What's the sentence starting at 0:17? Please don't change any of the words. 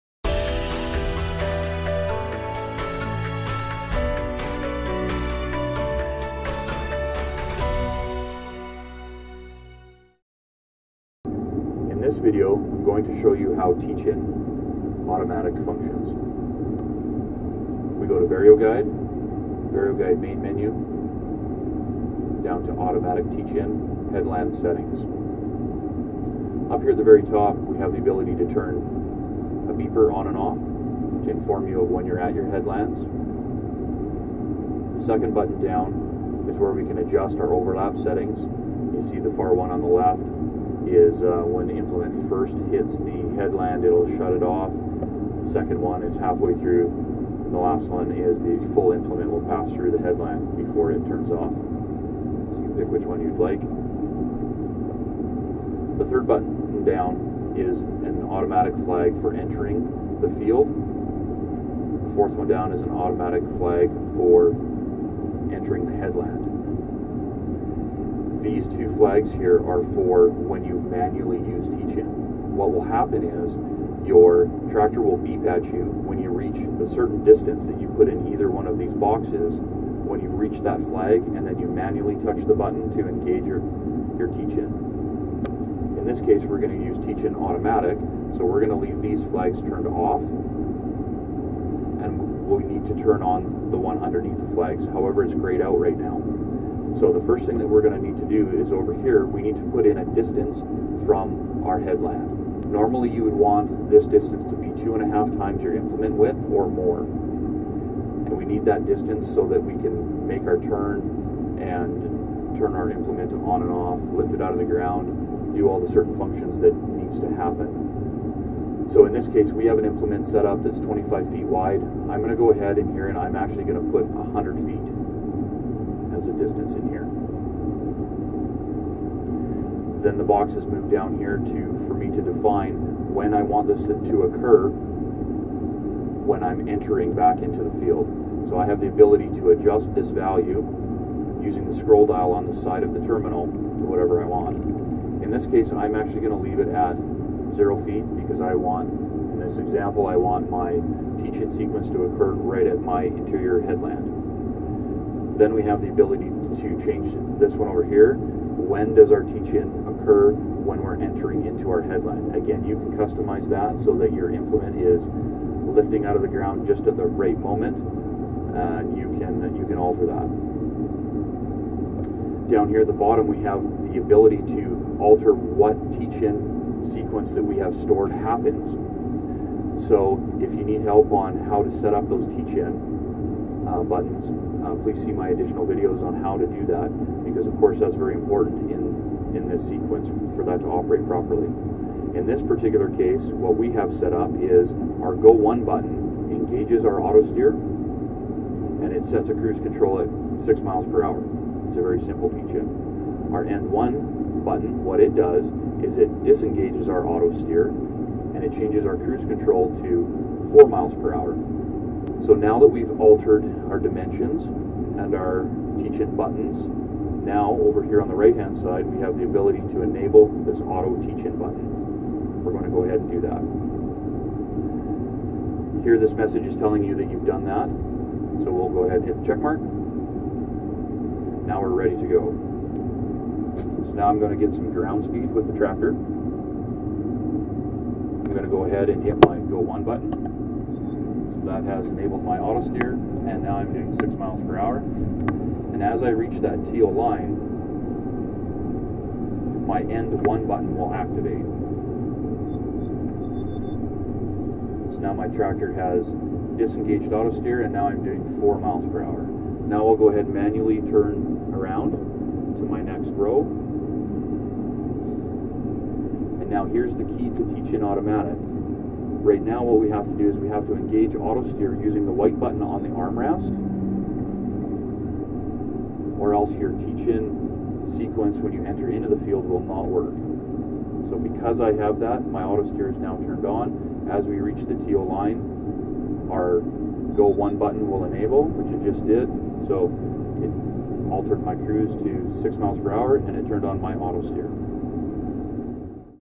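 We go to Vario Guide, Vario Guide main menu, down to automatic teach-in, Headland settings.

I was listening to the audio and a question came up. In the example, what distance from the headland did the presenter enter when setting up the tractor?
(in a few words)
100 feet.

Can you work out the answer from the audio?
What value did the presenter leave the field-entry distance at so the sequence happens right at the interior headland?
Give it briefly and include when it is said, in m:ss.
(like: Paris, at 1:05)
0 feet, at 2:27.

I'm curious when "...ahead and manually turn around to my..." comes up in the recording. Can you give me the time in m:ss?
4:20.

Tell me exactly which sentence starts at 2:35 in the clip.
Then we have the ability to change this one over here.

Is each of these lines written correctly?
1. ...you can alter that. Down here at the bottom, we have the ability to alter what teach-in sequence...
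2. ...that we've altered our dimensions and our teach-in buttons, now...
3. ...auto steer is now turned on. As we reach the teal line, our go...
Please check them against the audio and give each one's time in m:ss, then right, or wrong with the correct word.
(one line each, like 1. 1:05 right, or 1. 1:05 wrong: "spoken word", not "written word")
1. 2:49 right
2. 3:32 right
3. 4:42 right.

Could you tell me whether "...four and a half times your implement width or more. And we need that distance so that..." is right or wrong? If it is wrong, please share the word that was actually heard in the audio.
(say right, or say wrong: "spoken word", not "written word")
wrong: "two", not "four".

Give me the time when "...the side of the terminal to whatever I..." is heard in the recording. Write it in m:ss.
2:22.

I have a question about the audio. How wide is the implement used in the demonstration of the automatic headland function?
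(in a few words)
25 feet.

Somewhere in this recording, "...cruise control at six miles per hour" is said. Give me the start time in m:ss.
3:19.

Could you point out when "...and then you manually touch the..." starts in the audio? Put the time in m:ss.
1:21.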